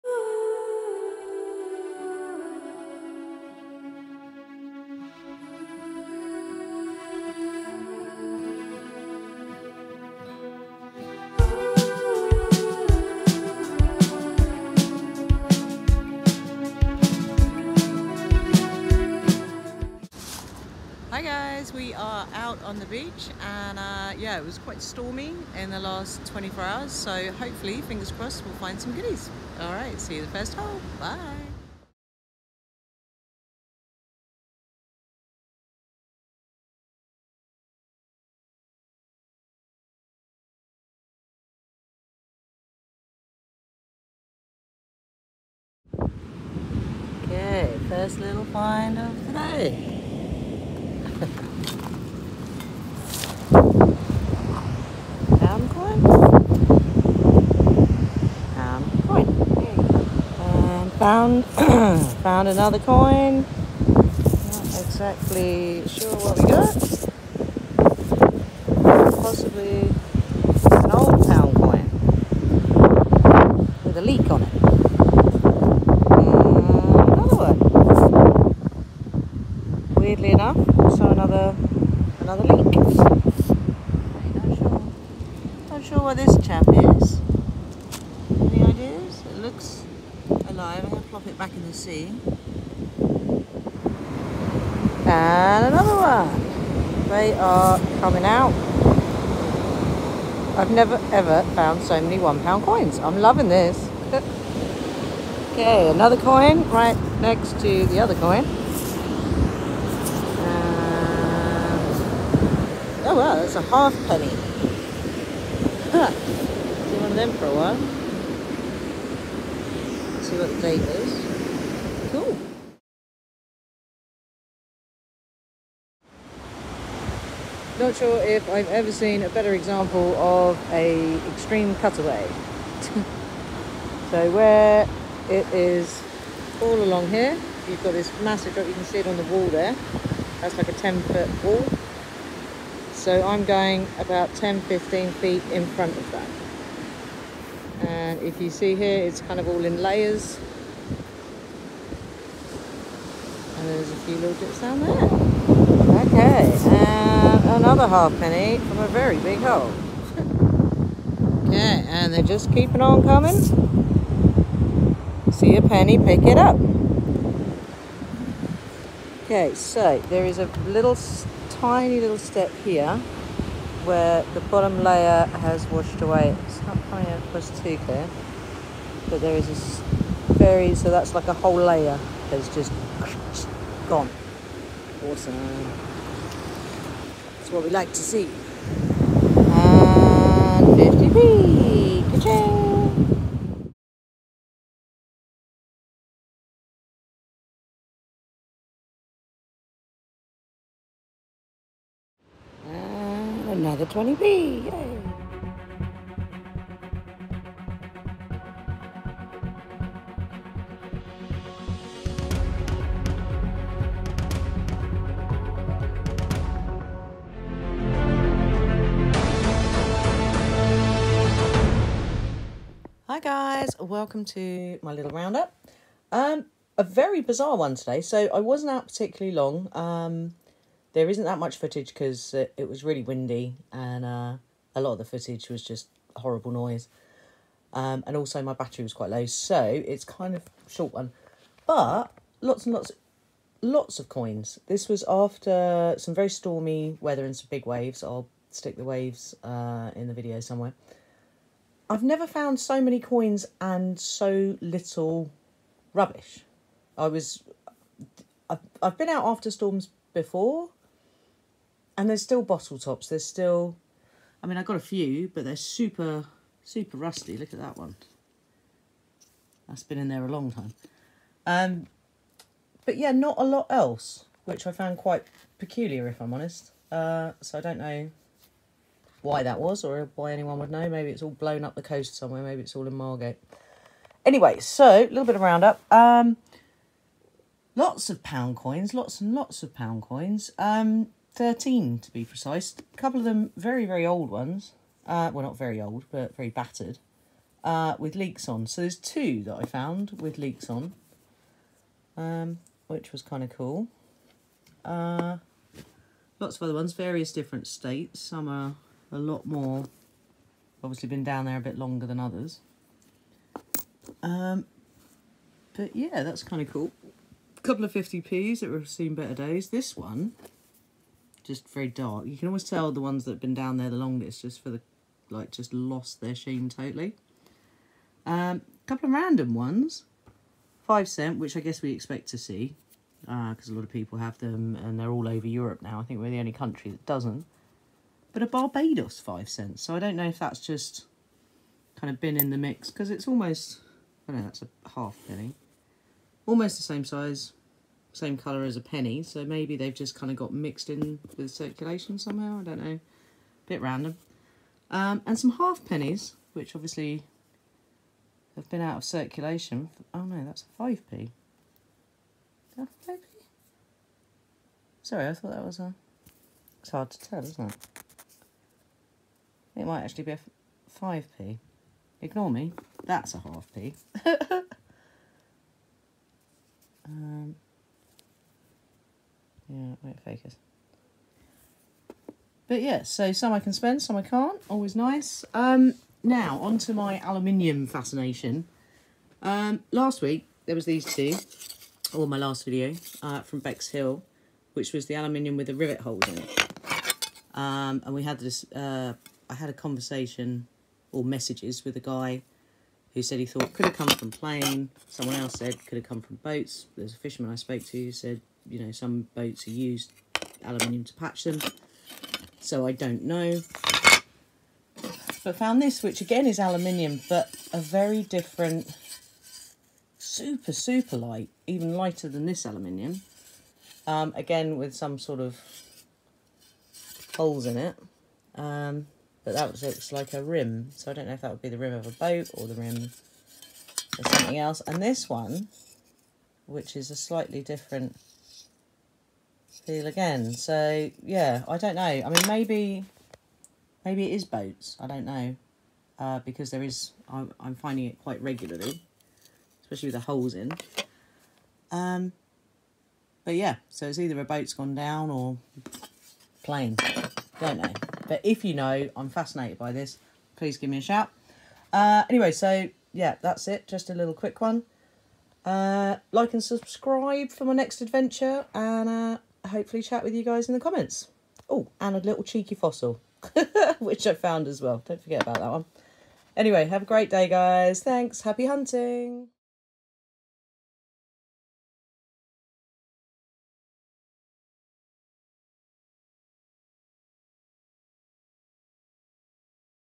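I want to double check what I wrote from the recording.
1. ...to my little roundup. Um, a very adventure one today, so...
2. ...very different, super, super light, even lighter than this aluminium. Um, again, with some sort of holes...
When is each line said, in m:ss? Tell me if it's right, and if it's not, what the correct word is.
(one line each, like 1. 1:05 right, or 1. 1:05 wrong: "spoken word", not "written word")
1. 3:44 wrong: "bizarre", not "adventure"
2. 6:57 right.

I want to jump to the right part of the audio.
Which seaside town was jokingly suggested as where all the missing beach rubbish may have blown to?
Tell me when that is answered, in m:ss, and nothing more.
4:42.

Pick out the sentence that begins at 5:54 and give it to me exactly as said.
Um, and some half pennies, which obviously have been out of circulation.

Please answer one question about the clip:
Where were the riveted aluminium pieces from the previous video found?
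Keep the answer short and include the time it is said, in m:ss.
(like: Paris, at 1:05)
Bexhill, at 6:33.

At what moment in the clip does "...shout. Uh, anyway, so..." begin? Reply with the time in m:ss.
7:41.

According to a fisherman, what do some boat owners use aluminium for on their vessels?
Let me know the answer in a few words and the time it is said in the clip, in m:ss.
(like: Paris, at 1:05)
To patch them, at 6:51.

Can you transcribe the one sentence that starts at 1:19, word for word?
Weirdly enough, so another another leak.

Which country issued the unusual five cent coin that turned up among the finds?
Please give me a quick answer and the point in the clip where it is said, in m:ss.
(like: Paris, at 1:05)
Barbados, at 5:38.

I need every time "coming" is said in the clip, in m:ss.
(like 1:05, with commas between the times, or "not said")
1:37, 2:43, 2:56.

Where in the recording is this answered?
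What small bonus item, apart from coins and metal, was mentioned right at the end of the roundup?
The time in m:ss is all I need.
7:52.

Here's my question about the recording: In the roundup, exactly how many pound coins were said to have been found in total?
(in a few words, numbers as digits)
13.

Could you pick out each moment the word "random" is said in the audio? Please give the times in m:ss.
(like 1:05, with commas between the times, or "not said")
5:29, 5:53.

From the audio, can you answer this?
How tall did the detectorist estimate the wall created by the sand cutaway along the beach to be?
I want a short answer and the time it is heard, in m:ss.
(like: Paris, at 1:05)
10 feet, at 2:20.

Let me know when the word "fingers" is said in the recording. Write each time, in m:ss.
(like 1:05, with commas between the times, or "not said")
0:27.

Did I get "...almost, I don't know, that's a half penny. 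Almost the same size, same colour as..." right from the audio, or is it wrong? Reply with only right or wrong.
right.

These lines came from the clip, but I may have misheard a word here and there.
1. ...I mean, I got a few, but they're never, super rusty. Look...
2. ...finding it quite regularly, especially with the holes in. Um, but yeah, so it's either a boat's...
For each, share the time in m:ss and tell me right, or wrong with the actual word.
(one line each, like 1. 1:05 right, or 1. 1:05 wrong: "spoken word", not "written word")
1. 4:24 wrong: "super", not "never"
2. 7:27 right.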